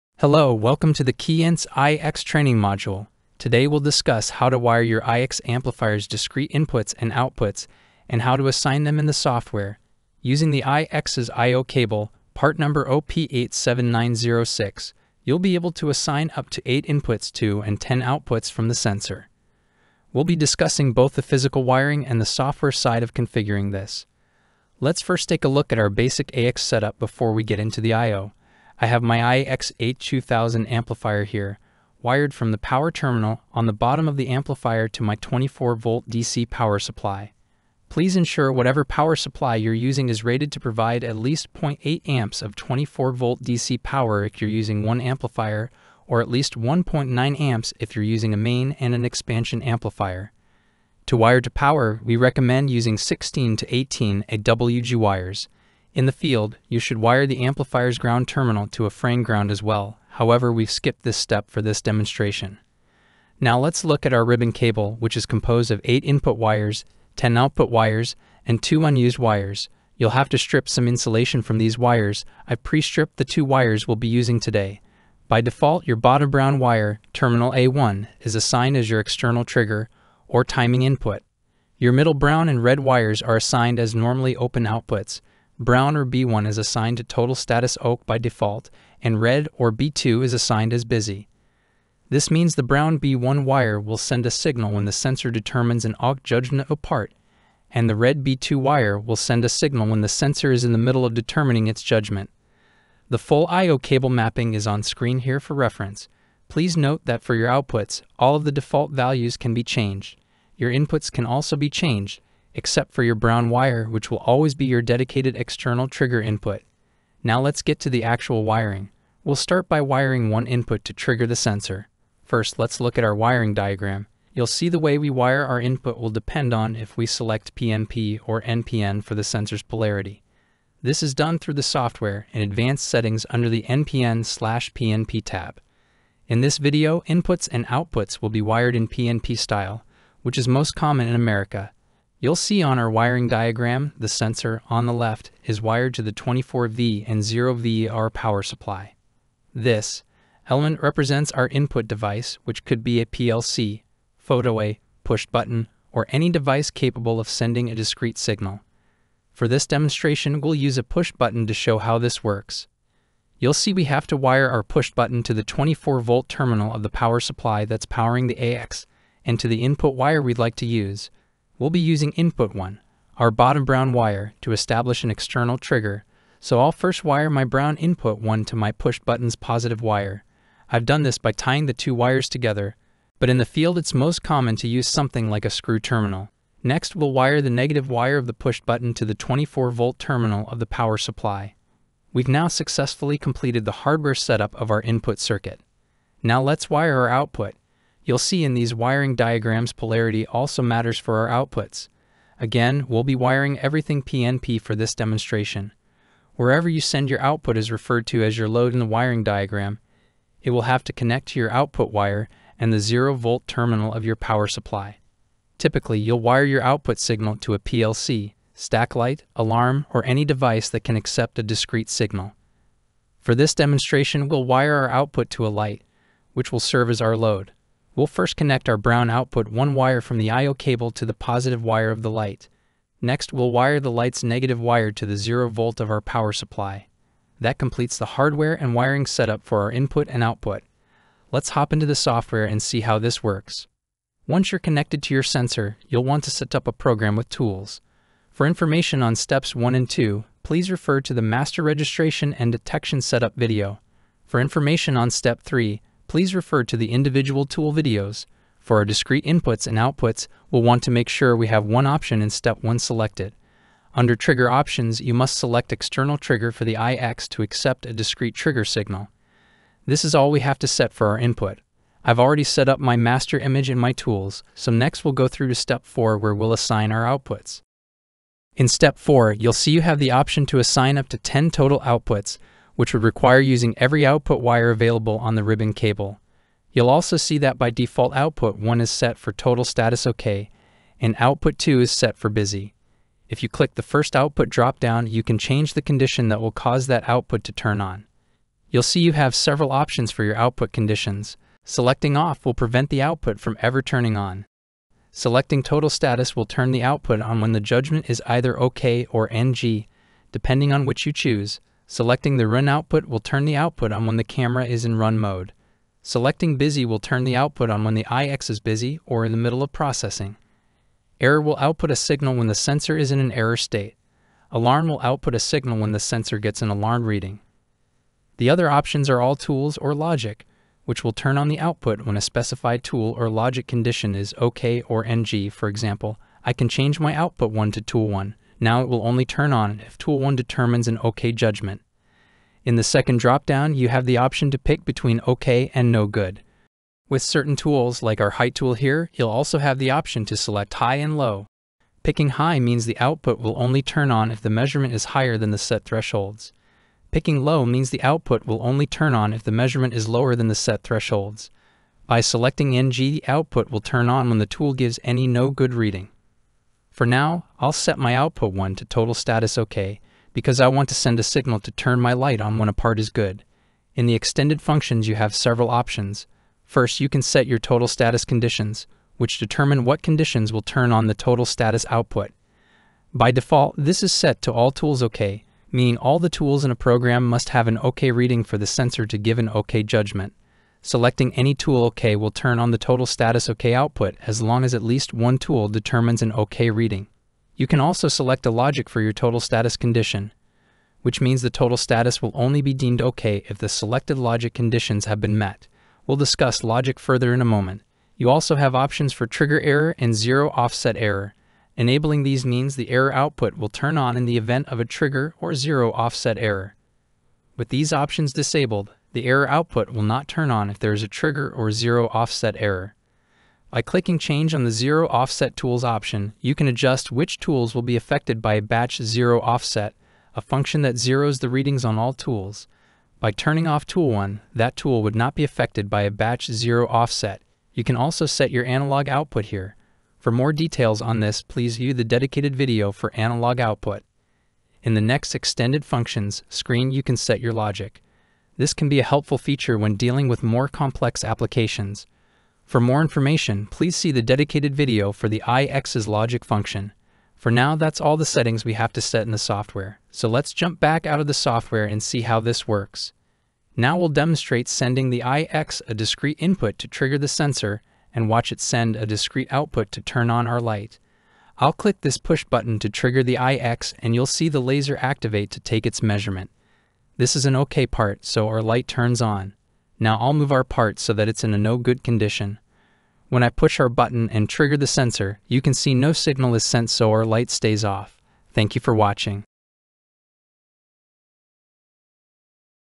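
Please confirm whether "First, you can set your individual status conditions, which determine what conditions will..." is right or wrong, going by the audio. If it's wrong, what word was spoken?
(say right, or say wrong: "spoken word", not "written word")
wrong: "total", not "individual".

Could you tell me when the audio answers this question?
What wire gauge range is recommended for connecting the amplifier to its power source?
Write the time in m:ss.
0:52.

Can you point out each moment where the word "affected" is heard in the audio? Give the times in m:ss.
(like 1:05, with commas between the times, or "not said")
7:07, 7:15.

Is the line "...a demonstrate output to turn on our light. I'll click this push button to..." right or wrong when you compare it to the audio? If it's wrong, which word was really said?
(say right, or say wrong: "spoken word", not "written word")
wrong: "discrete", not "demonstrate".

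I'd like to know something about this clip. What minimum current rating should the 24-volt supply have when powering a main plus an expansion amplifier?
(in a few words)
1.9 amps.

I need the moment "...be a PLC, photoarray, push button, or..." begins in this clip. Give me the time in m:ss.
2:32.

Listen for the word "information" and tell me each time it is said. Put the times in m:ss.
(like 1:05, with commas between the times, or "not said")
4:08, 4:14, 7:33.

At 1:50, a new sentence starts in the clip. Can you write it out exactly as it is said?
Your inputs can also be changed, except for your brown wire, which will always be your dedicated external trigger input.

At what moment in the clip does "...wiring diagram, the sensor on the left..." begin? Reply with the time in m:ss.
2:22.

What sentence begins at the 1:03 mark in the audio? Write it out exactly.
Now let's look at our ribbon cable, which is composed of 8 input wires, 10 output wires, and 2 unused wires.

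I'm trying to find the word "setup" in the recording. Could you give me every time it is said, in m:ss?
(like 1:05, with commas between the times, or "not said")
0:26, 3:14, 3:59, 4:13.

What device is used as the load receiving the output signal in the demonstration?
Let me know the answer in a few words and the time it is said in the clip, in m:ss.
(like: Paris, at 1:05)
a light, at 3:45.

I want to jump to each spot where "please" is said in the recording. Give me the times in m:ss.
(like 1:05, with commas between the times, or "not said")
0:37, 1:46, 4:10, 4:16, 7:21, 7:33.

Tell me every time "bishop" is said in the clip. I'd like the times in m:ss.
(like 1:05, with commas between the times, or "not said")
not said.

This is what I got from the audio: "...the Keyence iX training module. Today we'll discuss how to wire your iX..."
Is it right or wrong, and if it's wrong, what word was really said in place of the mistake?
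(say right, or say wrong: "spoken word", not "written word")
right.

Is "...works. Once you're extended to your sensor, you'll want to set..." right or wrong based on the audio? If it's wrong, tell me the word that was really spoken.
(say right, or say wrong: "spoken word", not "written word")
wrong: "connected", not "extended".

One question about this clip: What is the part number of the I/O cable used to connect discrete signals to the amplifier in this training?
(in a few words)
OP87906.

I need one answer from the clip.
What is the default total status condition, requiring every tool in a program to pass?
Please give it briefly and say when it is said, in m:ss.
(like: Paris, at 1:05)
all tools OK, at 6:24.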